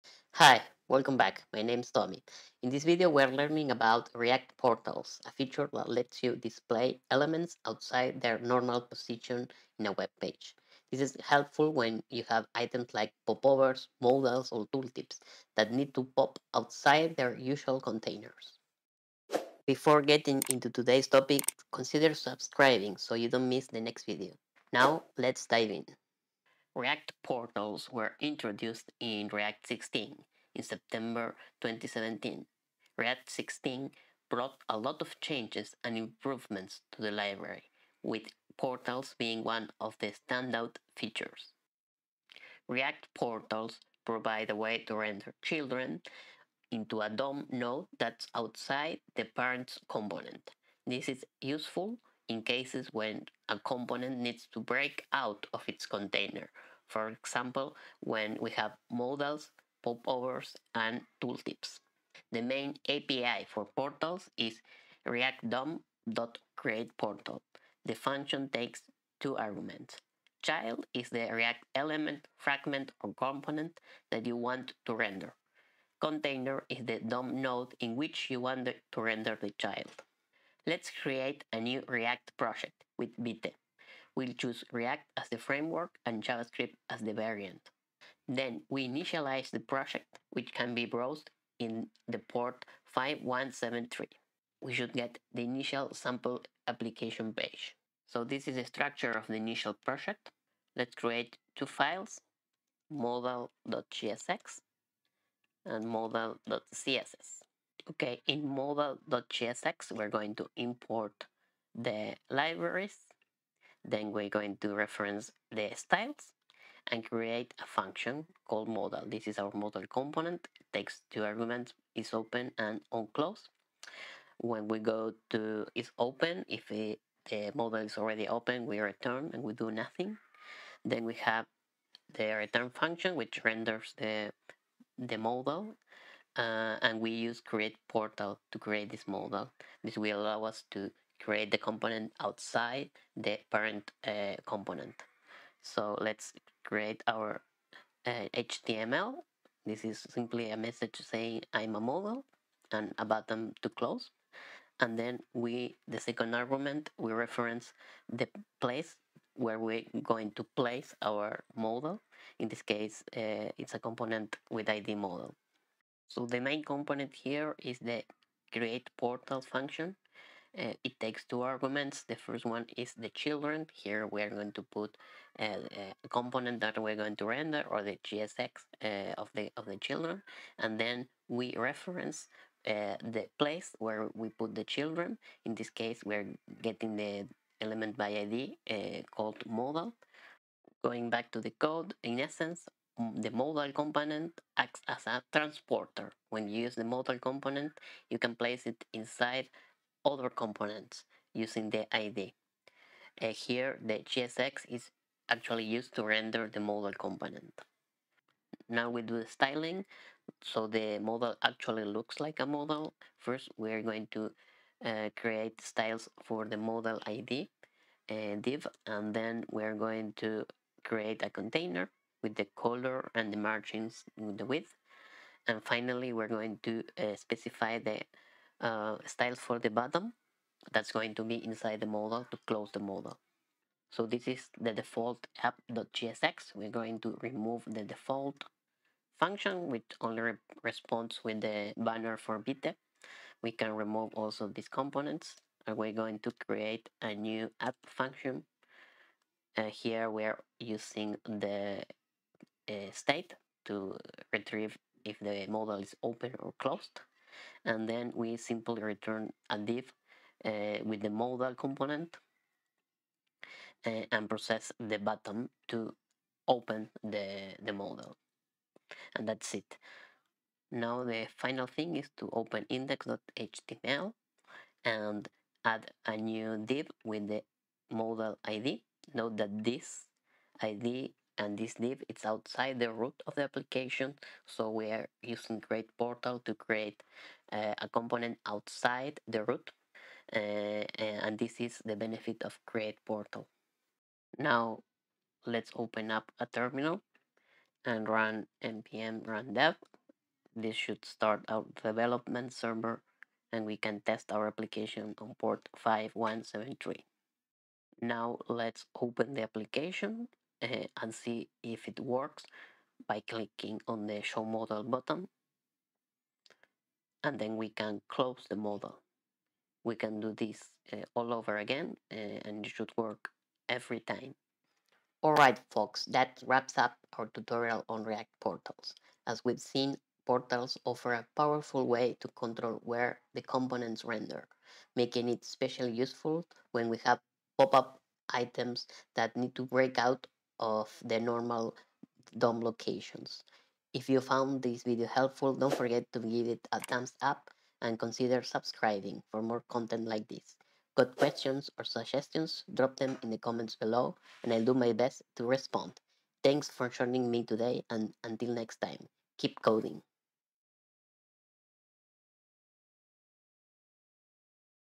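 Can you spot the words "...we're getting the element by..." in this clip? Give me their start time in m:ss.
3:06.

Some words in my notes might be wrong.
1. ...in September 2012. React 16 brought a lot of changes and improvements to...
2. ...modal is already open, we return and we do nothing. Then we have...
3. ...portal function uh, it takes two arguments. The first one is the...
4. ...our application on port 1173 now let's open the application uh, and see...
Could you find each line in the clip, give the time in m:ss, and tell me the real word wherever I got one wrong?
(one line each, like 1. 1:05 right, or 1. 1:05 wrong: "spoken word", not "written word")
1. 0:30 wrong: "2017", not "2012"
2. 2:07 right
3. 2:48 right
4. 5:04 wrong: "5173", not "1173".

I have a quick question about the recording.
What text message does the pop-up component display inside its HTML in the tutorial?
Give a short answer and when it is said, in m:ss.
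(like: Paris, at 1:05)
I'm a modal, at 2:31.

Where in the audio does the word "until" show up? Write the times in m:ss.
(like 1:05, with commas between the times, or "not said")
5:58.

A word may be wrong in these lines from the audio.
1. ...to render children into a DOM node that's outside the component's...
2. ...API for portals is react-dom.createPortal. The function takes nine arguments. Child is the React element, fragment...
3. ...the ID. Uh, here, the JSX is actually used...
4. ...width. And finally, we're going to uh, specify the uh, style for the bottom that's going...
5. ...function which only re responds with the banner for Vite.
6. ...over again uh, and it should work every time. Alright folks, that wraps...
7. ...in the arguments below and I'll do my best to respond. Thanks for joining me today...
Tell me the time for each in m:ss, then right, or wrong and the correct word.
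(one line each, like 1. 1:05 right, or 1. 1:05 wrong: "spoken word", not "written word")
1. 0:44 wrong: "parent", not "component"
2. 1:02 wrong: "two", not "nine"
3. 3:21 right
4. 3:44 right
5. 3:59 wrong: "BTEC", not "Vite"
6. 5:21 right
7. 5:53 wrong: "comments", not "arguments".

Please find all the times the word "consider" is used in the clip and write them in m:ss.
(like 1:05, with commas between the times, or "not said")
0:21, 5:47.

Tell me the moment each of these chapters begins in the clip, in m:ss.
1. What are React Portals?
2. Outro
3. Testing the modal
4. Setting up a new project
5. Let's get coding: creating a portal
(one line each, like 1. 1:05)
1. 0:26
2. 5:24
3. 5:08
4. 1:20
5. 1:41.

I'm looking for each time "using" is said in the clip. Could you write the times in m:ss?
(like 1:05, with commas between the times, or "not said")
3:21, 4:10, 4:45.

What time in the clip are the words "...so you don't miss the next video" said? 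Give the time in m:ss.
0:22.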